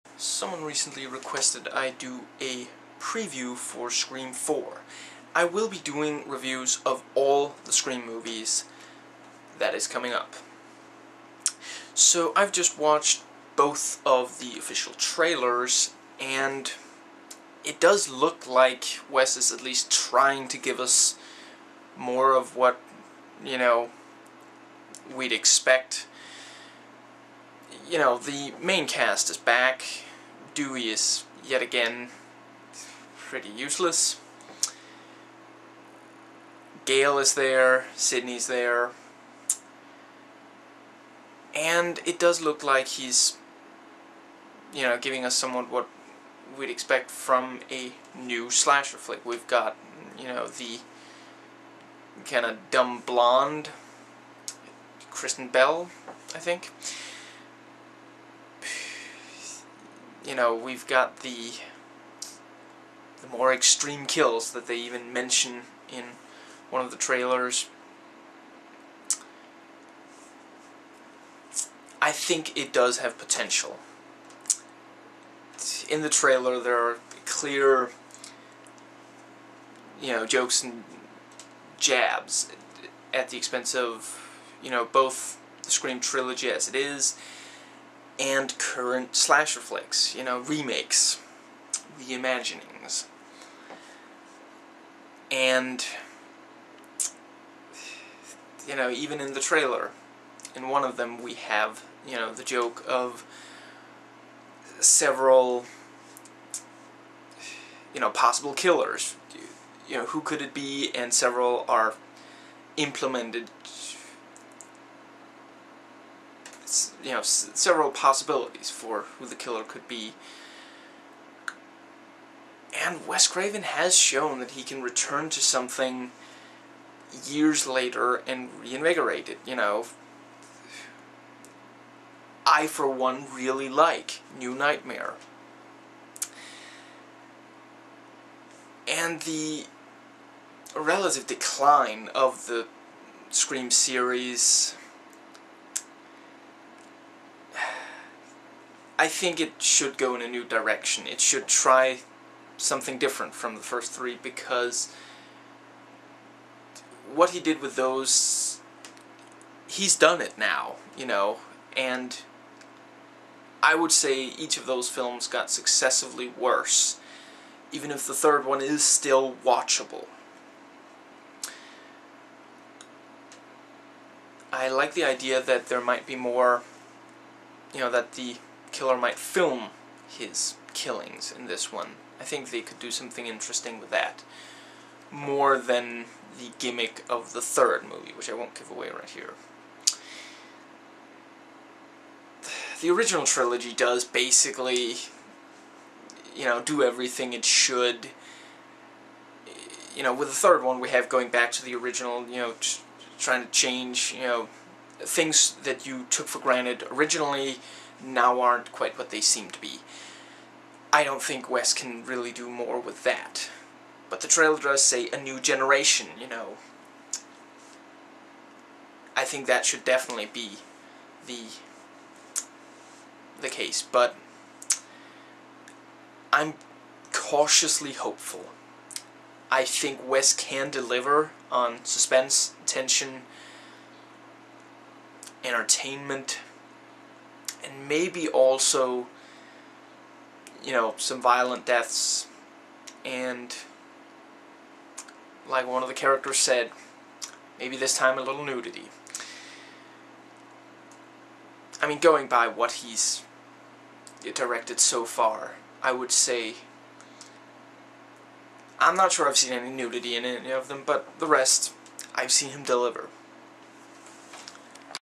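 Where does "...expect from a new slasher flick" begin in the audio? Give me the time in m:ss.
0:46.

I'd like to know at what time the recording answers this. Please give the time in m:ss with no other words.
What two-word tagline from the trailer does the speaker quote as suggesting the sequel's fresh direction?
3:35.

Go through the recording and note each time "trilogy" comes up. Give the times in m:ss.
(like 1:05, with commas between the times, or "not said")
1:25, 3:13.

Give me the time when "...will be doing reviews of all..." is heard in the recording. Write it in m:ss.
0:05.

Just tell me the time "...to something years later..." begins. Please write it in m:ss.
2:05.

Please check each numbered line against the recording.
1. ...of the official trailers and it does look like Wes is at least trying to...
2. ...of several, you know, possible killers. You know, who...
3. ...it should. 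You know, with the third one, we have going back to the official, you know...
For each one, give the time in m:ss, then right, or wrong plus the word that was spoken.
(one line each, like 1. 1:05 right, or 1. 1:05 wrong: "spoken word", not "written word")
1. 0:14 right
2. 1:42 right
3. 3:17 wrong: "original", not "official".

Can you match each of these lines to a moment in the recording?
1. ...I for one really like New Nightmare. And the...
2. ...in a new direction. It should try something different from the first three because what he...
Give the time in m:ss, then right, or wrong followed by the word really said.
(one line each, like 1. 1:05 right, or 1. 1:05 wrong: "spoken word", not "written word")
1. 2:12 right
2. 2:30 right.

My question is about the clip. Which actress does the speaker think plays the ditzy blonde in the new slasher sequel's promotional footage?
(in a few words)
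Kristen Bell.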